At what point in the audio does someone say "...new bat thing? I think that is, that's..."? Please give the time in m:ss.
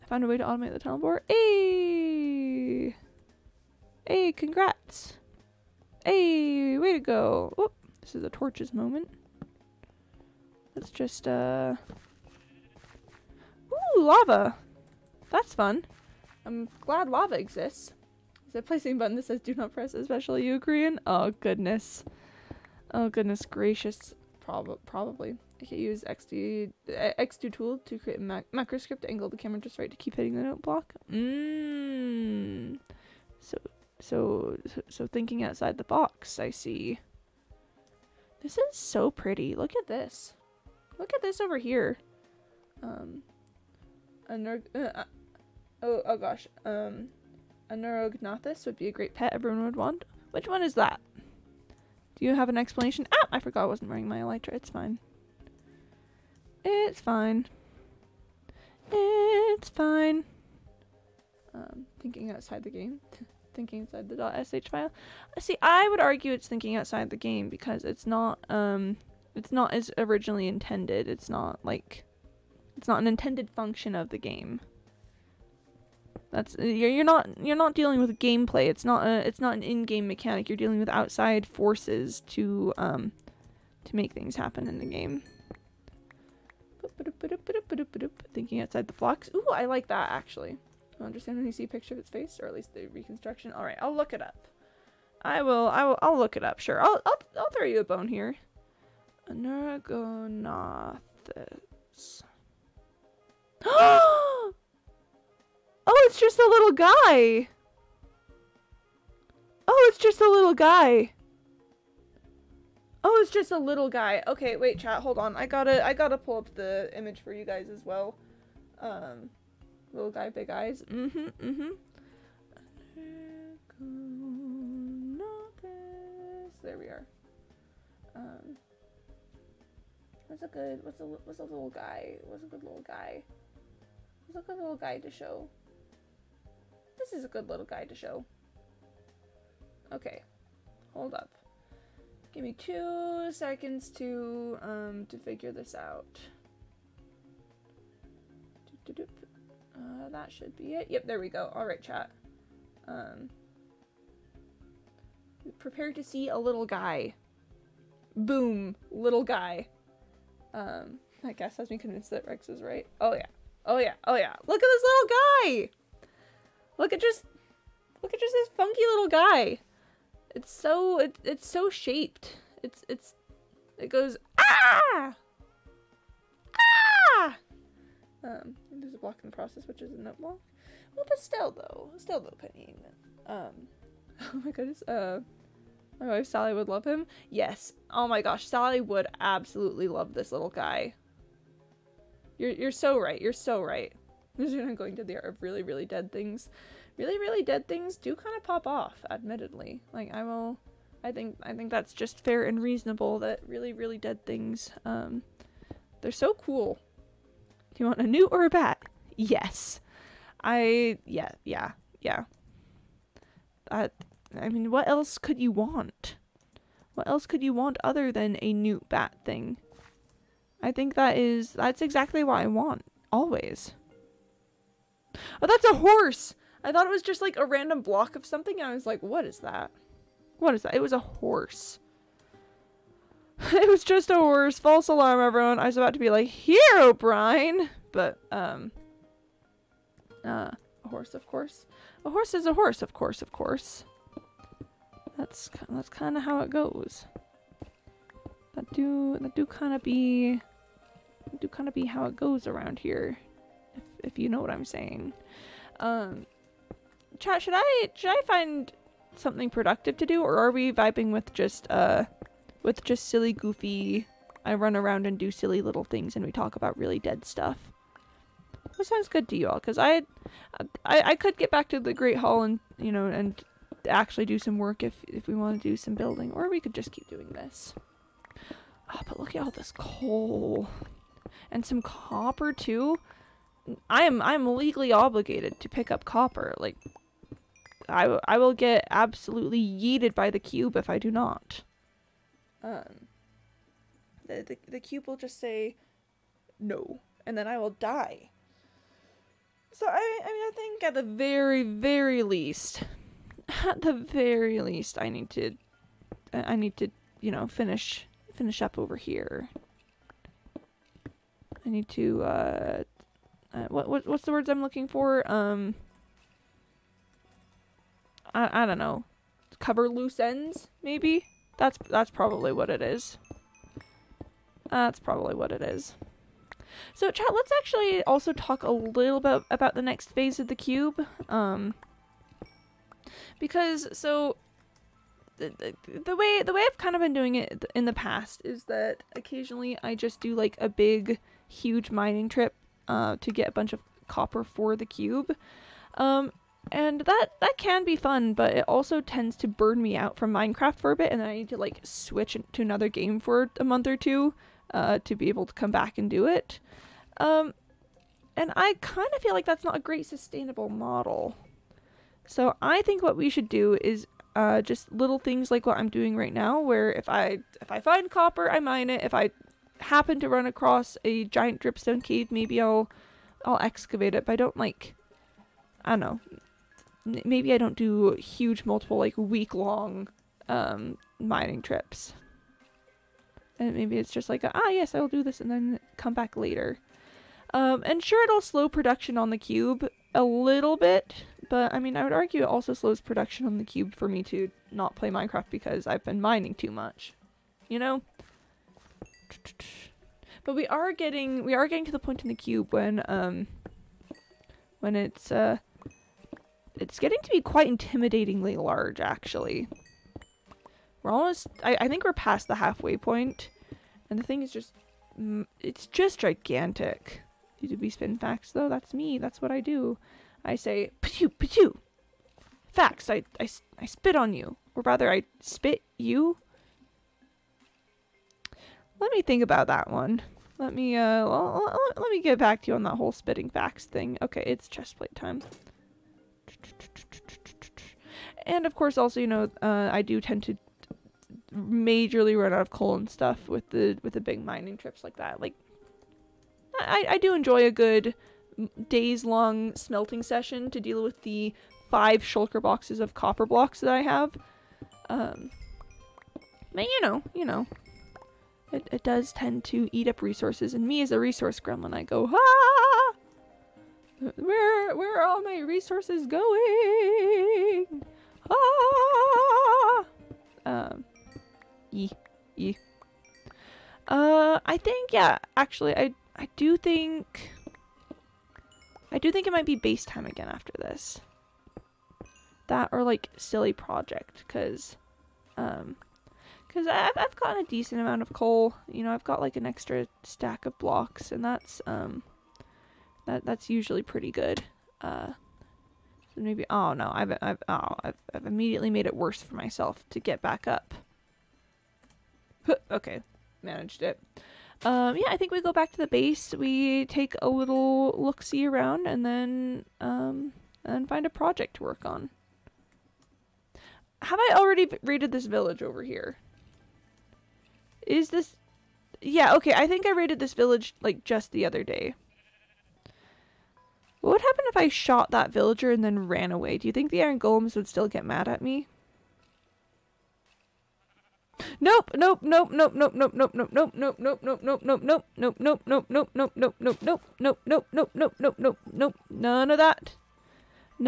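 3:38.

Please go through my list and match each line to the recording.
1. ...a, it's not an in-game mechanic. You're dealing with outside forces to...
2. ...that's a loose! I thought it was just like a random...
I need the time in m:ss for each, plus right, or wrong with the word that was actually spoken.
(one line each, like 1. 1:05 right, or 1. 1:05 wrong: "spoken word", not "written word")
1. 1:19 right
2. 3:45 wrong: "horse", not "loose".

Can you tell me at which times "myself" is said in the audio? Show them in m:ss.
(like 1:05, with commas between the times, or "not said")
8:19.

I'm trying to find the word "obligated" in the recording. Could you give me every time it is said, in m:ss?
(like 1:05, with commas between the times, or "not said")
4:44.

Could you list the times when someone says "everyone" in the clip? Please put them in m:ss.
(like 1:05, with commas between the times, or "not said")
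0:49, 3:55.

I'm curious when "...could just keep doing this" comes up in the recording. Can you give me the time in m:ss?
4:36.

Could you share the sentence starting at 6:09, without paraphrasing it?
If I happen to run across a giant dripstone cave, maybe I'll I'll excavate it.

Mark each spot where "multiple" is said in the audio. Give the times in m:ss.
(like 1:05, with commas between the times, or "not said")
6:18.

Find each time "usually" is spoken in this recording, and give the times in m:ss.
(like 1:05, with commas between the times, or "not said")
8:13.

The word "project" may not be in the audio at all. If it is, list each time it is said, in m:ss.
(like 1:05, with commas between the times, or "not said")
8:03, 8:31.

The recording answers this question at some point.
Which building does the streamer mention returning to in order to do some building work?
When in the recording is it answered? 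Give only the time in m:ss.
4:31.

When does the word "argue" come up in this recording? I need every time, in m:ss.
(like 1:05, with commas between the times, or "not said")
1:05, 6:32.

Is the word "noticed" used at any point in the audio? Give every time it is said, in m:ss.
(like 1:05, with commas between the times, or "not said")
not said.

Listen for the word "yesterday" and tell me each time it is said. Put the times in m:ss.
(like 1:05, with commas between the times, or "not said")
not said.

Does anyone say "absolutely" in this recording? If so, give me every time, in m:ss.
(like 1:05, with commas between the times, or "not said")
3:09, 4:48.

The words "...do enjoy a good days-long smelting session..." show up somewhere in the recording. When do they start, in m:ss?
7:27.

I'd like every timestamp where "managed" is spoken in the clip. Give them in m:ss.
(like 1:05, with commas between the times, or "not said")
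8:23.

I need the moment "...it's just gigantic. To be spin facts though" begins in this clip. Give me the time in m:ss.
6:55.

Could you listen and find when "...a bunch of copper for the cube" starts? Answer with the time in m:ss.
5:43.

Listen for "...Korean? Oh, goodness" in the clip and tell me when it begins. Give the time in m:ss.
0:20.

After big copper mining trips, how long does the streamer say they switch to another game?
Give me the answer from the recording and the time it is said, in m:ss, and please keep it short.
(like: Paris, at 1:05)
A month or two, at 5:53.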